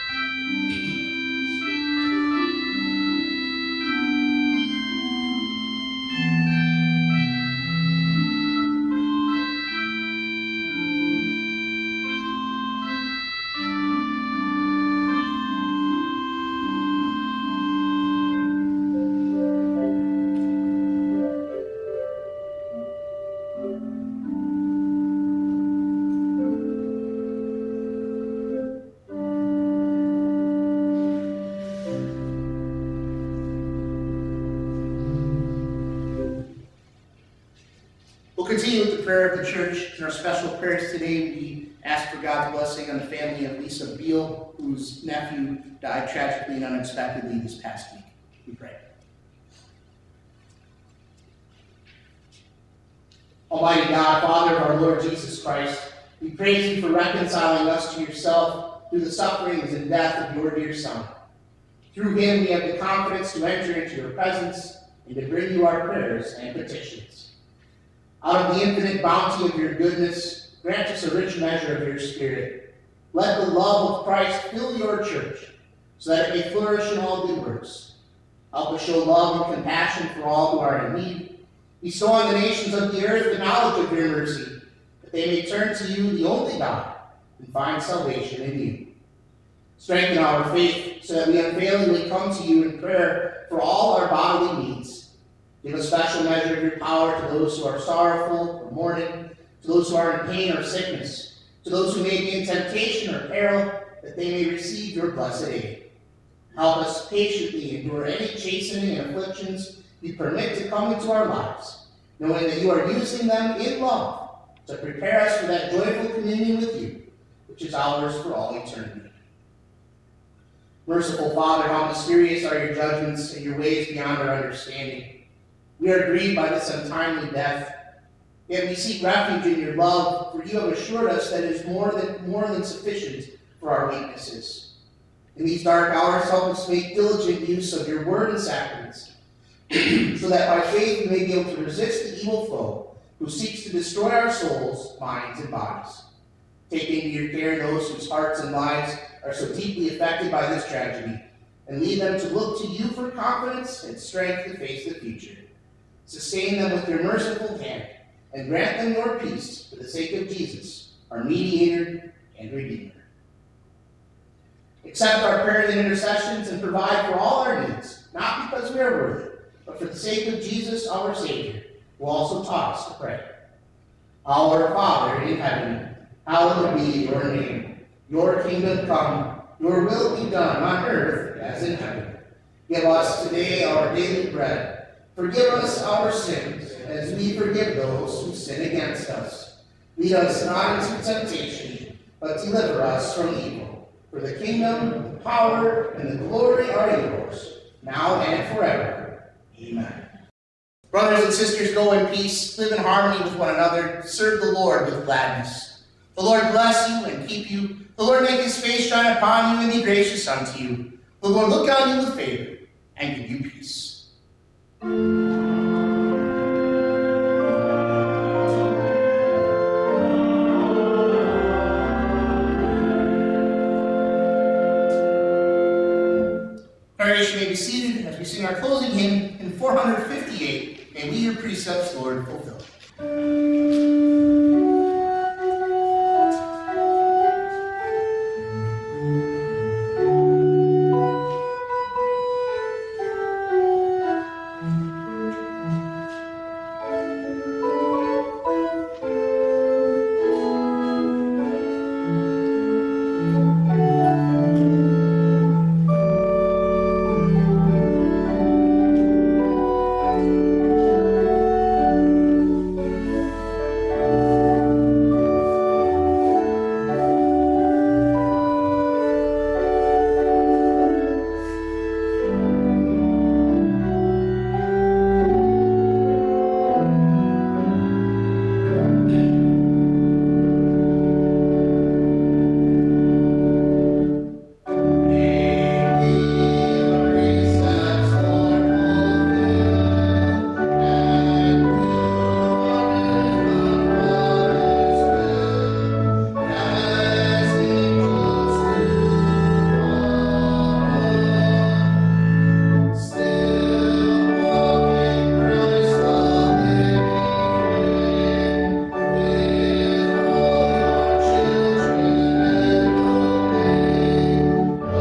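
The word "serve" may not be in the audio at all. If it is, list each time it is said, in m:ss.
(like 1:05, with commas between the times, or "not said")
3:24.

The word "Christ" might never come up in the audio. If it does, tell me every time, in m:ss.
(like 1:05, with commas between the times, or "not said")
0:55, 1:14.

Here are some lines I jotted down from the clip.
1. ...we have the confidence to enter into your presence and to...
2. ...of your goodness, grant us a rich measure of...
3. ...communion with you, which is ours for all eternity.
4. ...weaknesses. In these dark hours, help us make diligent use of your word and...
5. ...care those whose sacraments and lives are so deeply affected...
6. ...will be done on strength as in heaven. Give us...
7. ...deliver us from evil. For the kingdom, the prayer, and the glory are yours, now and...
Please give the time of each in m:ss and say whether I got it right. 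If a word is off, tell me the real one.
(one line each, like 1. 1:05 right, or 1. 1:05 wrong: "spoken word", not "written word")
1. 1:02 right
2. 1:09 right
3. 1:56 right
4. 2:13 right
5. 2:27 wrong: "hearts", not "sacraments"
6. 2:59 wrong: "earth", not "strength"
7. 3:12 wrong: "power", not "prayer".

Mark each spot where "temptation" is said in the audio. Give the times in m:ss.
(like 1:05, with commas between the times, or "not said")
1:42, 3:11.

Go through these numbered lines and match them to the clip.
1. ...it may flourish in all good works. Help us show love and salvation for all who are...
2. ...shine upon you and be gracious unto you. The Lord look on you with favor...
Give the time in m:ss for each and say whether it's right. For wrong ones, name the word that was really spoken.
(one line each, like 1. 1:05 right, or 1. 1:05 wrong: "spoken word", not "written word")
1. 1:16 wrong: "compassion", not "salvation"
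2. 3:28 right.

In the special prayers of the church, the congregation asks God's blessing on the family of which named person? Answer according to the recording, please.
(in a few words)
Lisa Beal.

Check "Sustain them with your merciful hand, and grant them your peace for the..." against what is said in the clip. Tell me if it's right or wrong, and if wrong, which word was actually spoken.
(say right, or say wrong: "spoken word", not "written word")
right.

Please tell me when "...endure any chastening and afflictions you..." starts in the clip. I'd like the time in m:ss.
1:47.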